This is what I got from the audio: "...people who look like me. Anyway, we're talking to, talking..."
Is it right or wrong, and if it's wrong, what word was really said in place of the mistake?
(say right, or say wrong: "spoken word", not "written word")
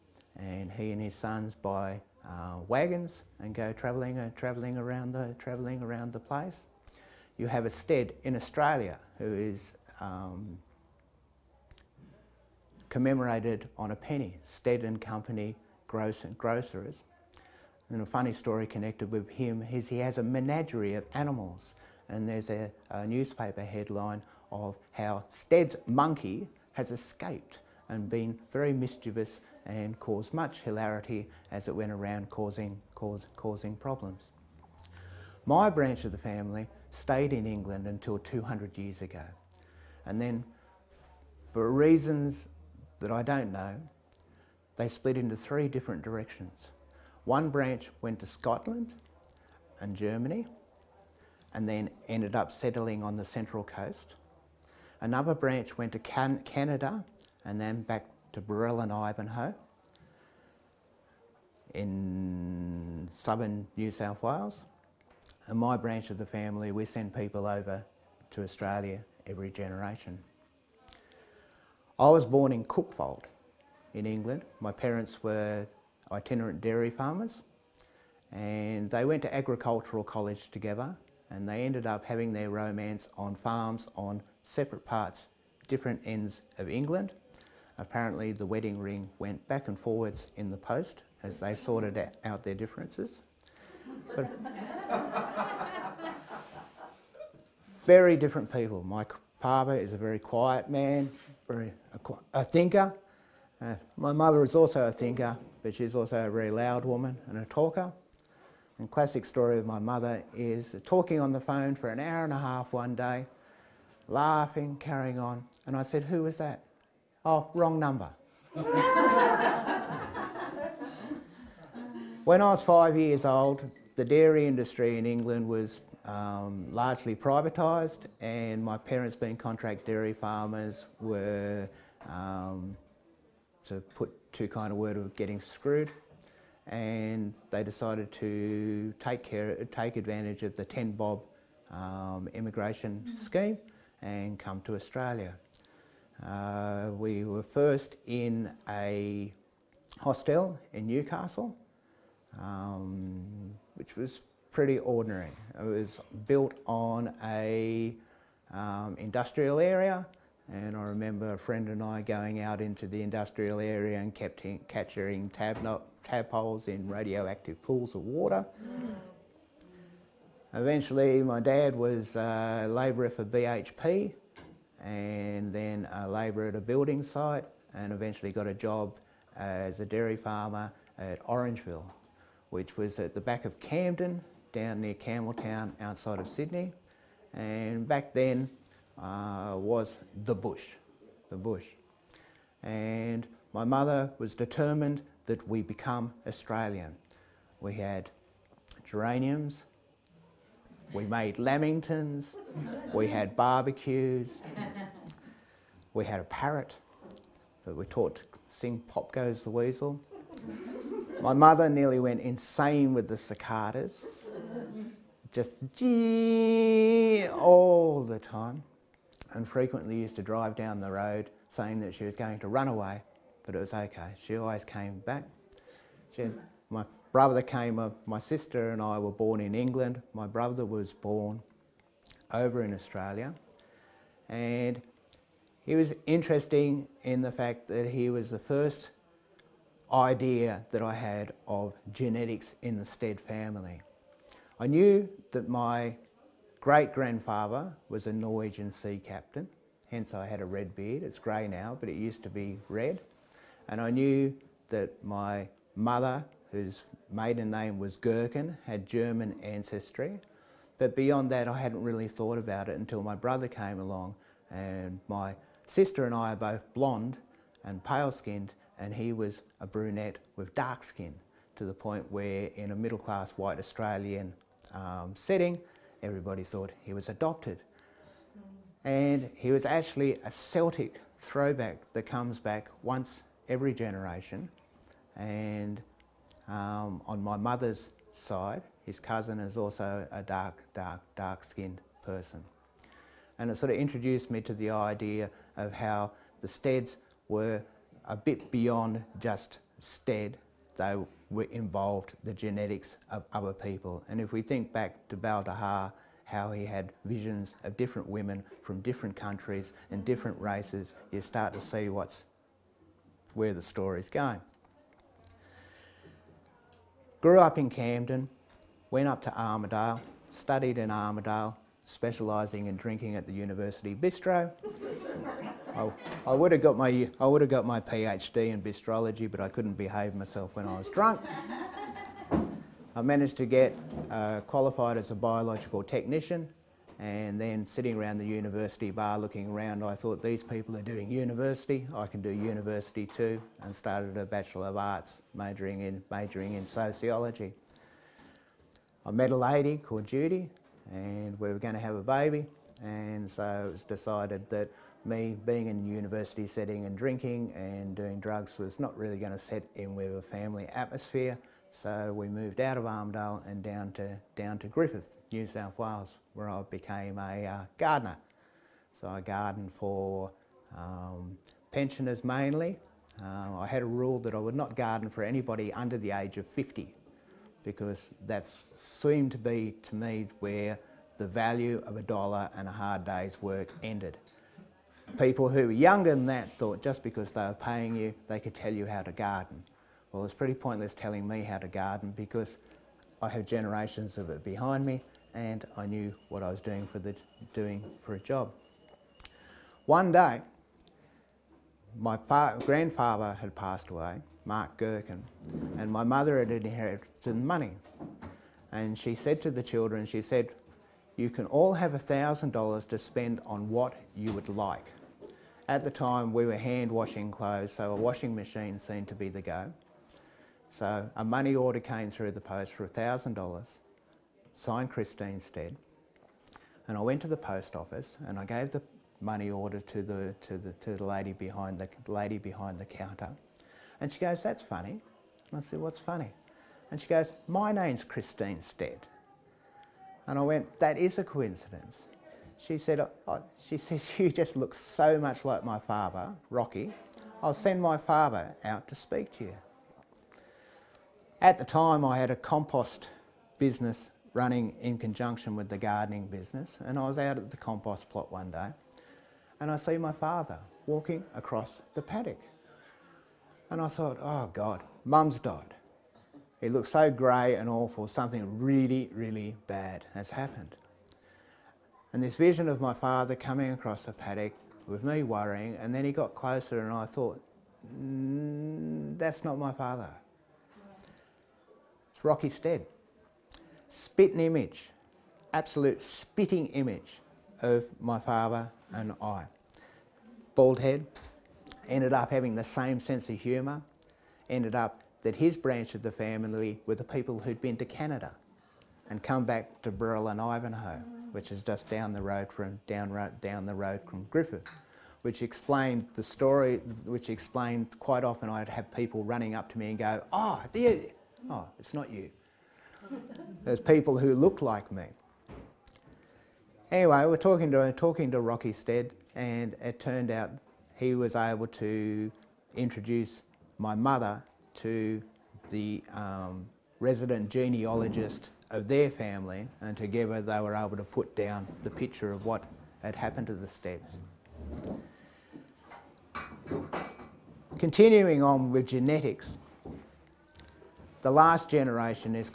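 right.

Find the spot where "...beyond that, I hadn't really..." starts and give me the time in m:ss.
4:20.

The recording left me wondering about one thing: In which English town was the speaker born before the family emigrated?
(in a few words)
Cuckfield.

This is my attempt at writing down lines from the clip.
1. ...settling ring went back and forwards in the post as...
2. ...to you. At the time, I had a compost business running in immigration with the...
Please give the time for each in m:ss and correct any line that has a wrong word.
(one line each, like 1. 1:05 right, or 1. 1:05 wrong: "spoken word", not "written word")
1. 1:28 wrong: "wedding", not "settling"
2. 7:29 wrong: "conjunction", not "immigration".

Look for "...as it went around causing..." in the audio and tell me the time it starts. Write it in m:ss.
0:31.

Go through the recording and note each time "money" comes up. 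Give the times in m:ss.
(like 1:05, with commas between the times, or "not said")
6:47, 7:01, 7:09.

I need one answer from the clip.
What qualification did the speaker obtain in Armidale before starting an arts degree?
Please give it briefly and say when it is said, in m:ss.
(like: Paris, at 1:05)
Biological technician, at 5:35.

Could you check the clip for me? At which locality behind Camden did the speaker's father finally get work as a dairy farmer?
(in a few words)
Orangeville.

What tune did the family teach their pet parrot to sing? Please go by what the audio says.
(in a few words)
Pop Goes the Weasel.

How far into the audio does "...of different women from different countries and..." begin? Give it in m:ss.
5:07.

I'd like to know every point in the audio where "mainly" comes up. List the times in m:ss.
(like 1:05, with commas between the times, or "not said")
6:12.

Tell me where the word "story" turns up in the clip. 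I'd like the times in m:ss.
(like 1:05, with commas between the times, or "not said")
0:18, 1:49, 5:13, 8:26.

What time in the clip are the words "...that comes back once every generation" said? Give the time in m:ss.
4:41.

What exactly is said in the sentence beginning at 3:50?
My brother was born over in Australia.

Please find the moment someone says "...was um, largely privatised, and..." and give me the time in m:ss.
2:05.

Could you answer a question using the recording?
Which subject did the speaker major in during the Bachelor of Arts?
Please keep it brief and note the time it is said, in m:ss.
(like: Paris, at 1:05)
Sociology, at 5:46.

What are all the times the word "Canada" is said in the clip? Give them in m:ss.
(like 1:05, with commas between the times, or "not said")
0:56, 8:17.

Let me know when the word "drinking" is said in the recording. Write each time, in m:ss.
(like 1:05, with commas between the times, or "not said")
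5:22, 5:56.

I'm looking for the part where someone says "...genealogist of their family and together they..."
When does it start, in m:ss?
8:47.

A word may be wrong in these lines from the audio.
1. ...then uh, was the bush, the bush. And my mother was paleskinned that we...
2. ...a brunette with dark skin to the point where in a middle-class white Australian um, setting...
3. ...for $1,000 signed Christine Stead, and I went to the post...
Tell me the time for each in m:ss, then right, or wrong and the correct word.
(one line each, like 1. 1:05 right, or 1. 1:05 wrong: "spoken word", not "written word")
1. 3:08 wrong: "determined", not "paleskinned"
2. 4:29 right
3. 7:02 right.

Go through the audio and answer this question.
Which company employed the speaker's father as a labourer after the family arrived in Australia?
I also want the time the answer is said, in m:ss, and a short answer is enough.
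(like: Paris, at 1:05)
BHP, at 2:53.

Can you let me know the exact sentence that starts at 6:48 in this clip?
And she said to the children, she said, you can all have $1,000 to spend on what you would like.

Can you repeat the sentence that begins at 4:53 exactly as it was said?
And it sort of introduced me to the idea of how the steads were a bit beyond just stead.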